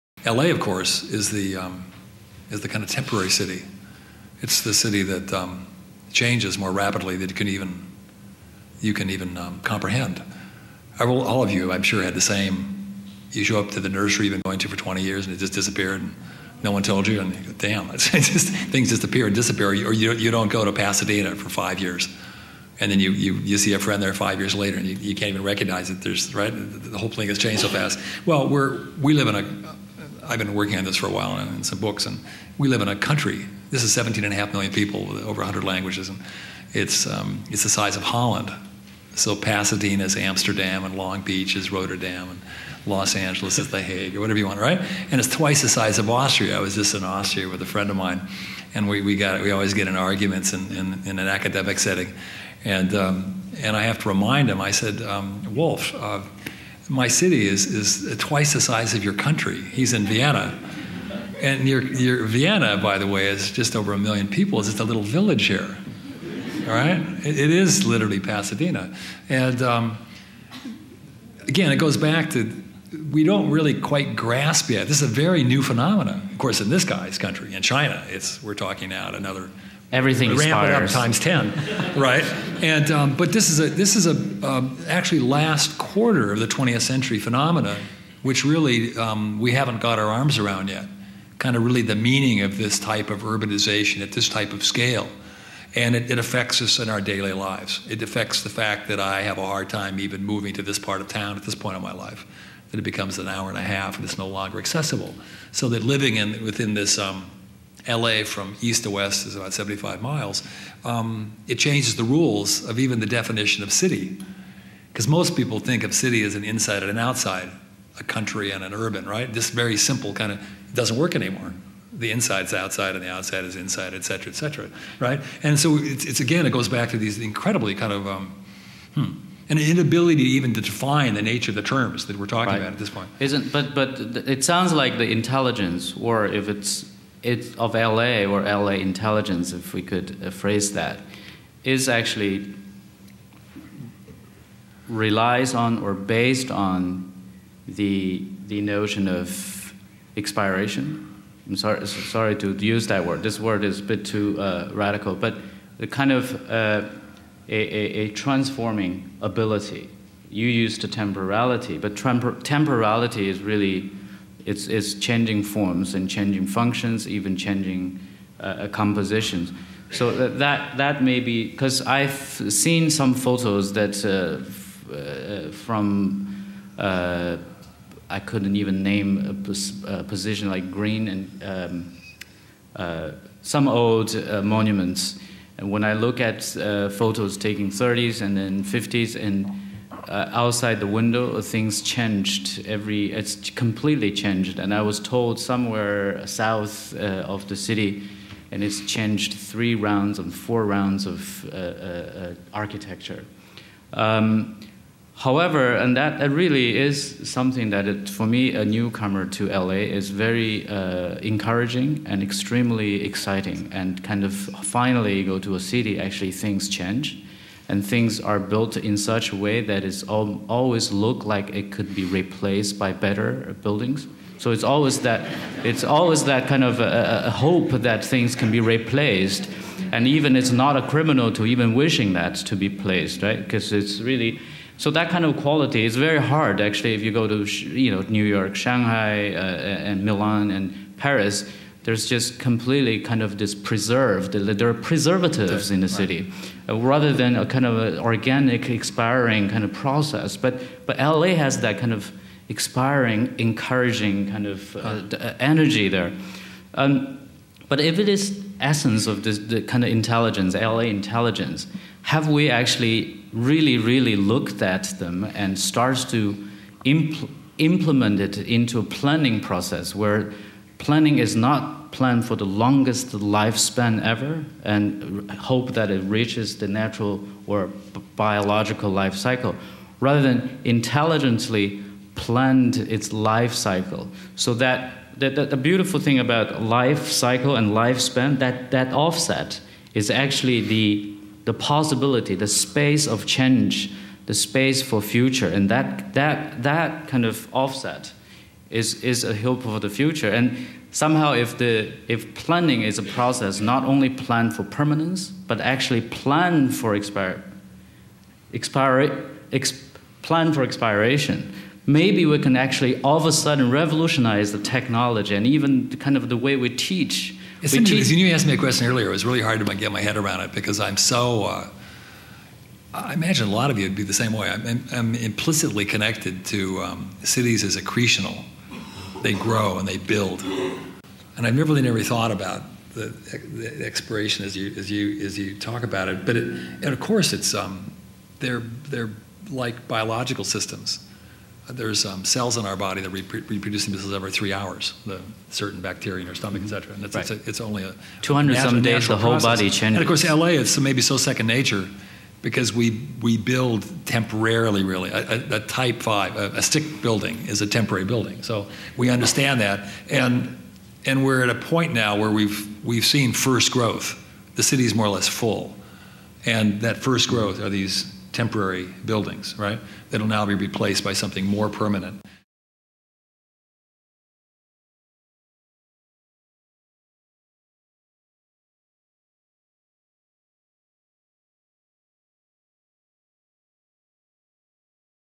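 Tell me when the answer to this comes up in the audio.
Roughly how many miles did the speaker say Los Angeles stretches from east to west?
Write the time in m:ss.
1:49.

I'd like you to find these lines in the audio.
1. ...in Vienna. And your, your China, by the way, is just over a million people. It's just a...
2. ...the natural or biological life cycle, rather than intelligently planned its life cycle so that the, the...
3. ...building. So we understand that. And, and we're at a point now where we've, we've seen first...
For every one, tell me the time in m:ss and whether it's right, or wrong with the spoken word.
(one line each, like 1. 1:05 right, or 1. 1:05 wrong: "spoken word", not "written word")
1. 0:59 wrong: "Vienna", not "China"
2. 4:36 right
3. 5:58 right.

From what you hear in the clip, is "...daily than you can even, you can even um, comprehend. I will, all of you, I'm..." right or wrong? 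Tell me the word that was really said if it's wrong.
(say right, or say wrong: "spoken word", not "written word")
wrong: "rapidly", not "daily".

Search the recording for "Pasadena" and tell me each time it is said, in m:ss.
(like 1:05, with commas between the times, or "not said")
0:20, 0:39, 1:08.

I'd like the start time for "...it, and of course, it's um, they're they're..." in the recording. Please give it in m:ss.
5:36.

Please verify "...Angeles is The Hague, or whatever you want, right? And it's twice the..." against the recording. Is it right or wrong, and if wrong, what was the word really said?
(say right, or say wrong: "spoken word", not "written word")
right.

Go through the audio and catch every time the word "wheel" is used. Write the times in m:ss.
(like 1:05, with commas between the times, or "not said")
not said.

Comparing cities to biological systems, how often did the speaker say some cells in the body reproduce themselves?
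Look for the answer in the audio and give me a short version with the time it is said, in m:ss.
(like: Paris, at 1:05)
every 3 hours, at 5:44.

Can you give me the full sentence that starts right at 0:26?
There's right the whole thing has changed so fast.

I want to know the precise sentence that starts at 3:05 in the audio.
And when I look at photos taken 30s and then 50s and uh, outside the window, things changed every, it's completely changed.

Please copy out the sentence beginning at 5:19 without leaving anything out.
It was really hard to get my head around it because I'm so.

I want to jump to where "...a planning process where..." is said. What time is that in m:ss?
4:28.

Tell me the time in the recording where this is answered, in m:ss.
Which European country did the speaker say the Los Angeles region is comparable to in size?
0:38.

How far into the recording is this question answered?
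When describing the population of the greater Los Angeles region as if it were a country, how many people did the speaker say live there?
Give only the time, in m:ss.
0:33.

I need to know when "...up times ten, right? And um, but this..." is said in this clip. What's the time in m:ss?
1:20.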